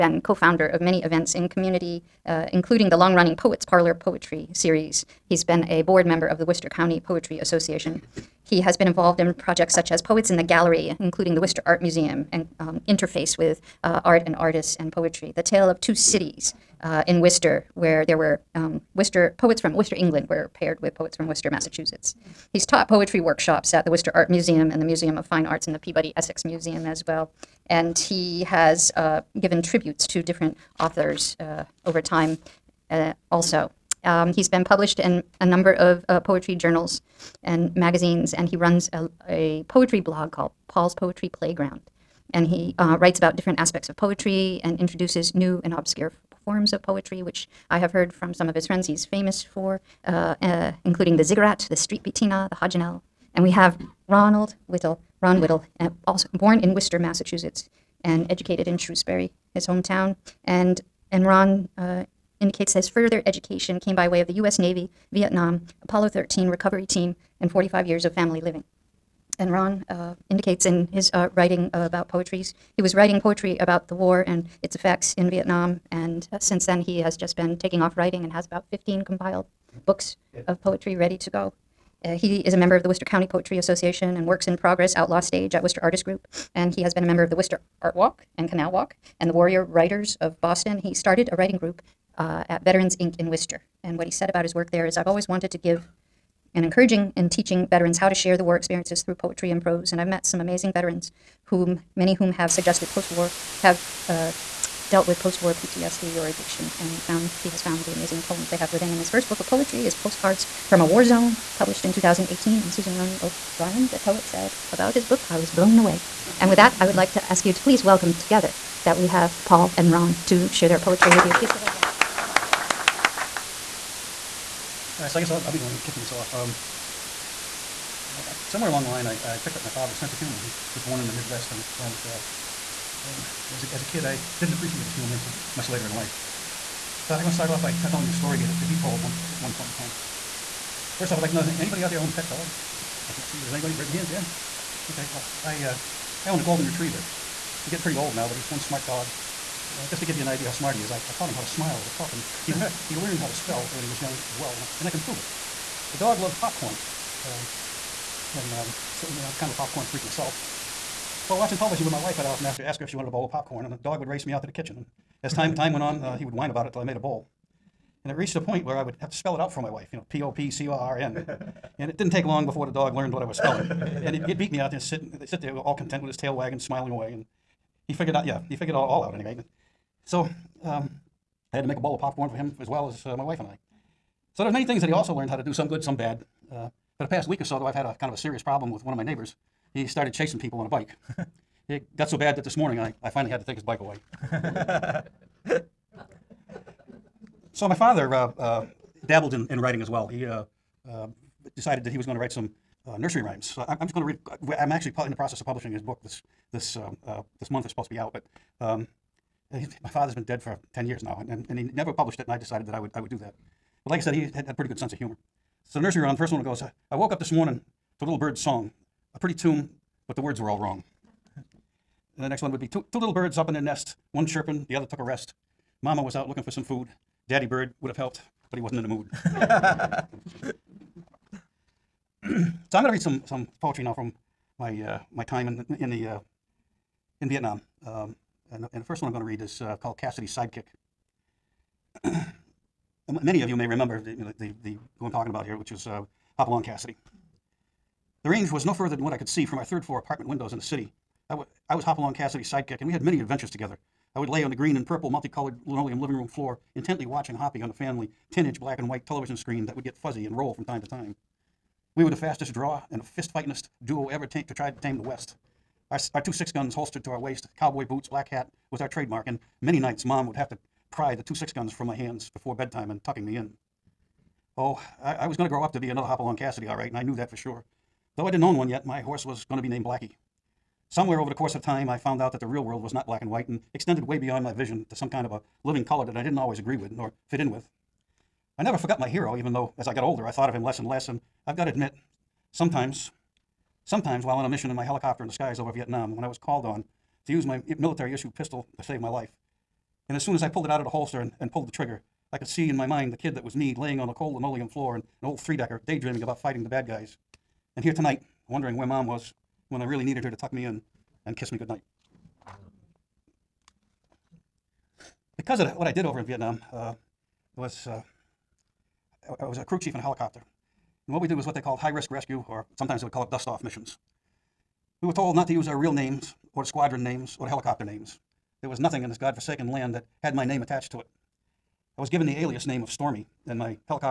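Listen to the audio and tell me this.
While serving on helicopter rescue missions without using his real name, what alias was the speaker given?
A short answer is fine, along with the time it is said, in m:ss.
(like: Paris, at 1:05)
Stormy, at 5:32.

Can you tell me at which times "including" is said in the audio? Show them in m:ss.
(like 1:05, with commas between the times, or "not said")
0:02, 0:10, 0:50.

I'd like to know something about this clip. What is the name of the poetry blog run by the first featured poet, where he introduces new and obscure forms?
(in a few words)
Paul's Poetry Playground.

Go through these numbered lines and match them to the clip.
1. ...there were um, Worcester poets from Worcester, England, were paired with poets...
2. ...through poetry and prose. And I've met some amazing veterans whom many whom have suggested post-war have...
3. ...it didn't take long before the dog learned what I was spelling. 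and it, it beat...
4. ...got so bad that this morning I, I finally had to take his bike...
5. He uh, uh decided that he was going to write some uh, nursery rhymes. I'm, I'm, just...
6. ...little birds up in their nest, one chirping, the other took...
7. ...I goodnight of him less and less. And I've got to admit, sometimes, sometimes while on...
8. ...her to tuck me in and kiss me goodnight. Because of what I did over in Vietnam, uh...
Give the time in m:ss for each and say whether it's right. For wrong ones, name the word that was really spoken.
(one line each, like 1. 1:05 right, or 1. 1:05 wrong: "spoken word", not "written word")
1. 0:18 right
2. 1:39 right
3. 2:51 right
4. 3:11 right
5. 3:20 right
6. 3:42 right
7. 4:50 wrong: "thought", not "goodnight"
8. 5:10 right.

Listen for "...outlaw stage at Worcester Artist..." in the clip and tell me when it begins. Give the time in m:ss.
1:24.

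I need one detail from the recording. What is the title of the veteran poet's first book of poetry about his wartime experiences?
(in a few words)
Postcards from a War Zone.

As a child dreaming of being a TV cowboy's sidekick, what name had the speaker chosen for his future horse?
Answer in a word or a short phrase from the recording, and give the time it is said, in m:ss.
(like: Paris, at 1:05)
Blackie, at 4:39.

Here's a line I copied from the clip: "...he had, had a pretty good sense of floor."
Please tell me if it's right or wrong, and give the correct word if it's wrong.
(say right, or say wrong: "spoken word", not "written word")
wrong: "humor", not "floor".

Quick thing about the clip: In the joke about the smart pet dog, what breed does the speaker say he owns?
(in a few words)
Golden retriever.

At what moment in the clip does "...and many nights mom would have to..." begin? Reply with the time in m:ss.
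4:29.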